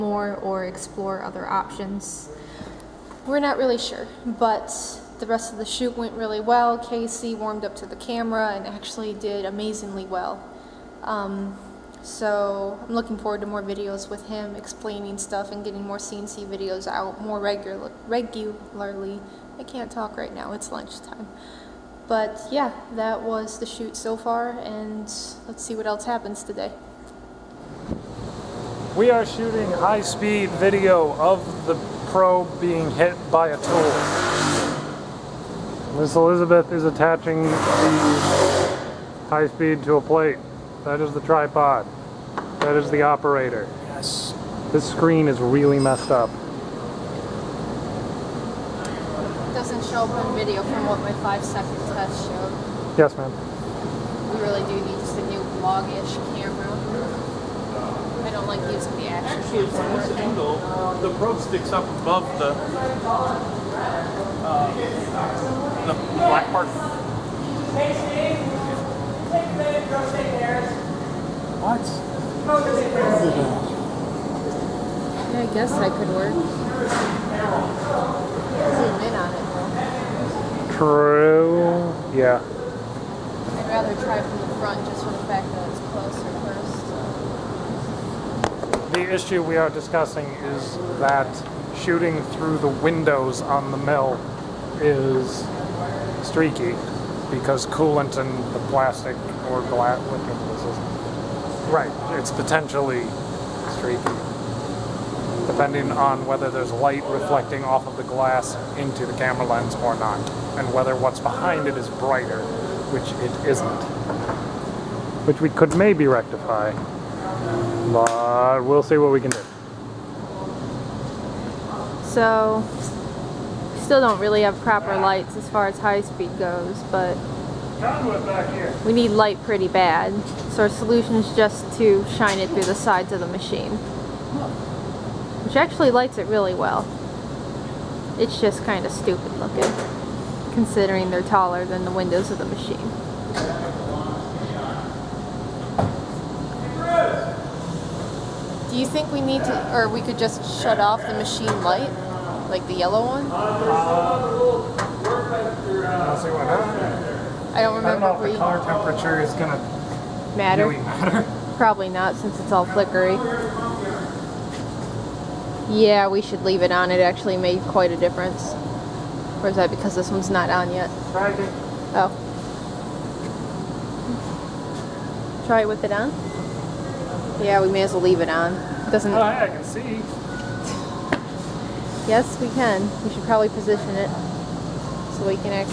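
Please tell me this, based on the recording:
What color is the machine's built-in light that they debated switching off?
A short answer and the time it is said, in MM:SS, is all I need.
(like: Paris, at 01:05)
Yellow, at 02:32.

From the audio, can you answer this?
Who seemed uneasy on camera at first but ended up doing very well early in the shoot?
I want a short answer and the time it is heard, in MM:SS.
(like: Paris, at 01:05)
Casey, at 00:06.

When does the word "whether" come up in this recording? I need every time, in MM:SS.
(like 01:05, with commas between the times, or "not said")
01:46, 01:50.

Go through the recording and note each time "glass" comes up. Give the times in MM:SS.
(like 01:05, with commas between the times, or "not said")
01:39, 01:48.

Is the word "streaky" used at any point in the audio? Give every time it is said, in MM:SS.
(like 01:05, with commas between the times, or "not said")
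01:36, 01:43.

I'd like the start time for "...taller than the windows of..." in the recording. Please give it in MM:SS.
02:21.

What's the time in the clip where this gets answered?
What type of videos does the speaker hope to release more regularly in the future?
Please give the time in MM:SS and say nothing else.
00:15.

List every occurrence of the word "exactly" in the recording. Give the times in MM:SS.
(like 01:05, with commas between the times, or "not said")
not said.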